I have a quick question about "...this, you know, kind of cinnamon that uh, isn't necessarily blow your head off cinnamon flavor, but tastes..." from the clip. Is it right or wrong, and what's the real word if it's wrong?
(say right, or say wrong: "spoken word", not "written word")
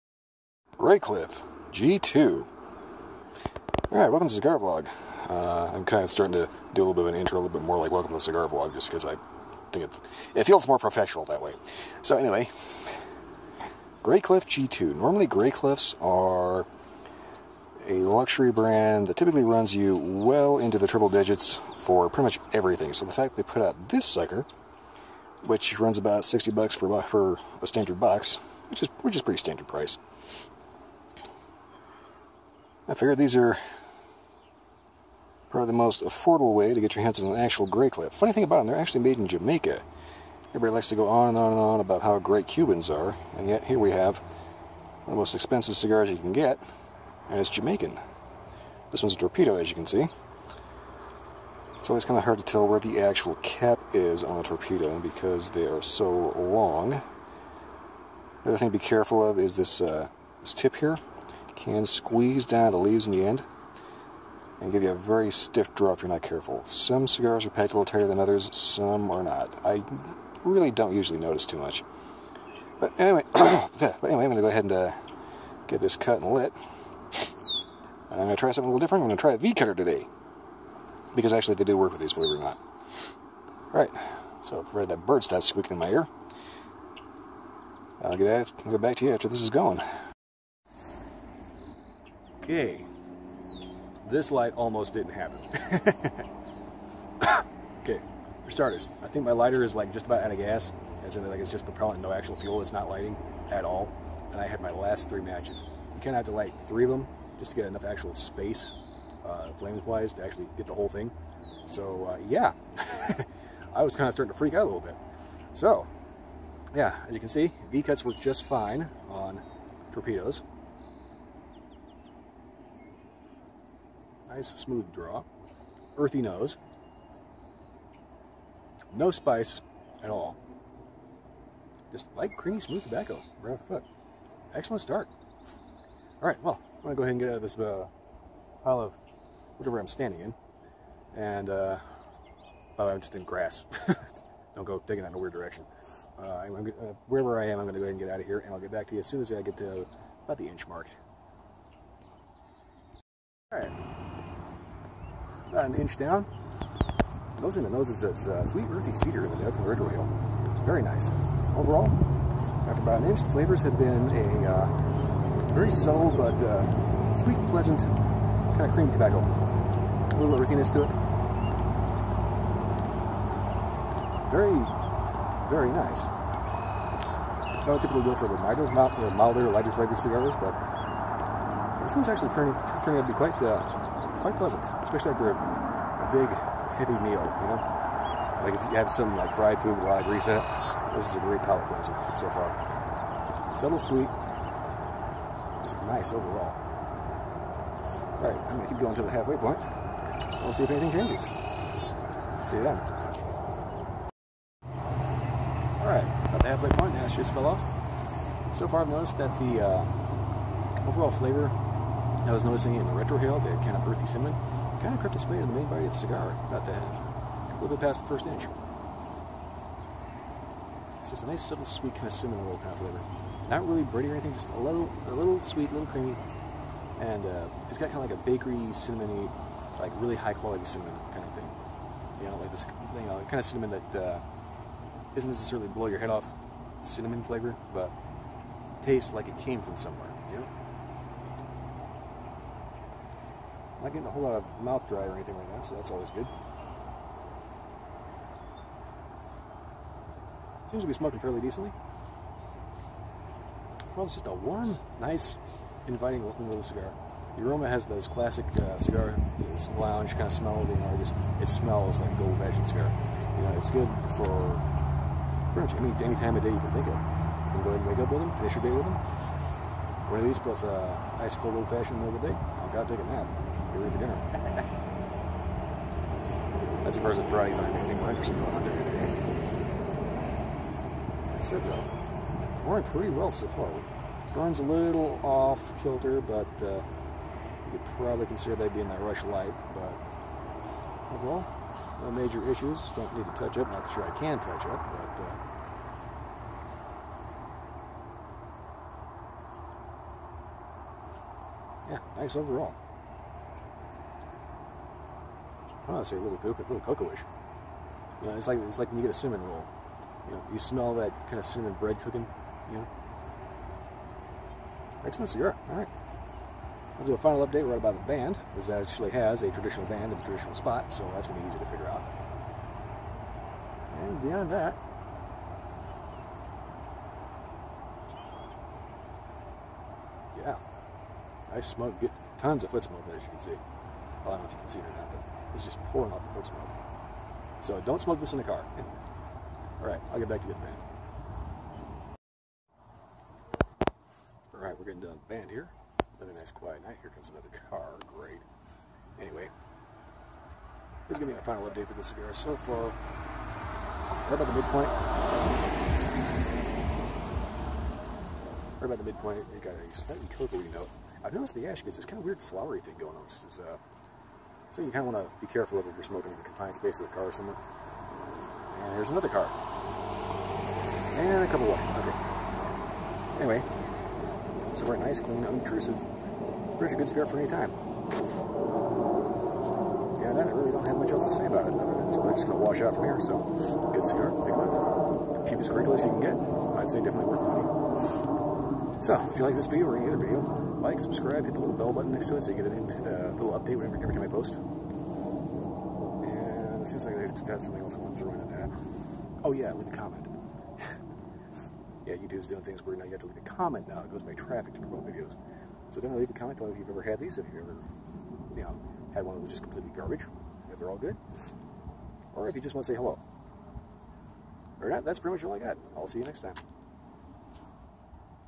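right.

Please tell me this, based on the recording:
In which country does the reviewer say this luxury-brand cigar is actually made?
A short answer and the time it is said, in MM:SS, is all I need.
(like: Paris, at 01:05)
Jamaica, at 00:39.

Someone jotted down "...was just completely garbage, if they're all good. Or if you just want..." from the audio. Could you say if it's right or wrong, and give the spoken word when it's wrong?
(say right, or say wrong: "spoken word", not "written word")
right.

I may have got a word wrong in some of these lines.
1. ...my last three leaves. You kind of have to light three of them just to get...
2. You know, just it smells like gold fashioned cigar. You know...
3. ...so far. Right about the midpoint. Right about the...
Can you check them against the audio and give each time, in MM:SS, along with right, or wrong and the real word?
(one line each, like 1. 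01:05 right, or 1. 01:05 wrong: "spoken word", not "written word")
1. 01:44 wrong: "matches", not "leaves"
2. 04:20 right
3. 05:52 right.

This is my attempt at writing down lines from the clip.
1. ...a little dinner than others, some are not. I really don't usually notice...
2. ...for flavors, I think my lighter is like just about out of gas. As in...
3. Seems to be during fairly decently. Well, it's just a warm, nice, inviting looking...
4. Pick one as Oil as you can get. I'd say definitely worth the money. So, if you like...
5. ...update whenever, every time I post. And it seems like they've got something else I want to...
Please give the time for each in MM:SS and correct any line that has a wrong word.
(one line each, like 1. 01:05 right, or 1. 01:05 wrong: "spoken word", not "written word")
1. 01:07 wrong: "tighter", not "dinner"
2. 01:38 wrong: "starters", not "flavors"
3. 04:10 wrong: "smoking", not "during"
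4. 06:24 wrong: "Cheapest", not "Oil"
5. 06:33 right.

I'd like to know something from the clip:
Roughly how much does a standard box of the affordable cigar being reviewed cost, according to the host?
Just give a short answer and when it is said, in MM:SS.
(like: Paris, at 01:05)
$60, at 00:26.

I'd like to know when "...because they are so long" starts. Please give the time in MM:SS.
00:54.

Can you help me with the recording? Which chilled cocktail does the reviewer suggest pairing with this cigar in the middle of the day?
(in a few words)
Old fashioned.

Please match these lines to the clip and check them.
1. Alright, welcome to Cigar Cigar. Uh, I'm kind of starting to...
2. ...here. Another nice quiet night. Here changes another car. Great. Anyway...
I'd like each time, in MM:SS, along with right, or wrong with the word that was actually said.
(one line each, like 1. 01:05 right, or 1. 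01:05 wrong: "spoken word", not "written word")
1. 00:03 wrong: "Vlog", not "Cigar"
2. 05:45 wrong: "comes", not "changes".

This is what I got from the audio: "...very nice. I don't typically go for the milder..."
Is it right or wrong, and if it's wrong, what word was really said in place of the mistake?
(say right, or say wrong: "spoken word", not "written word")
right.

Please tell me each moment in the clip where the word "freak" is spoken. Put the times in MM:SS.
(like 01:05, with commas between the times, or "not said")
01:54.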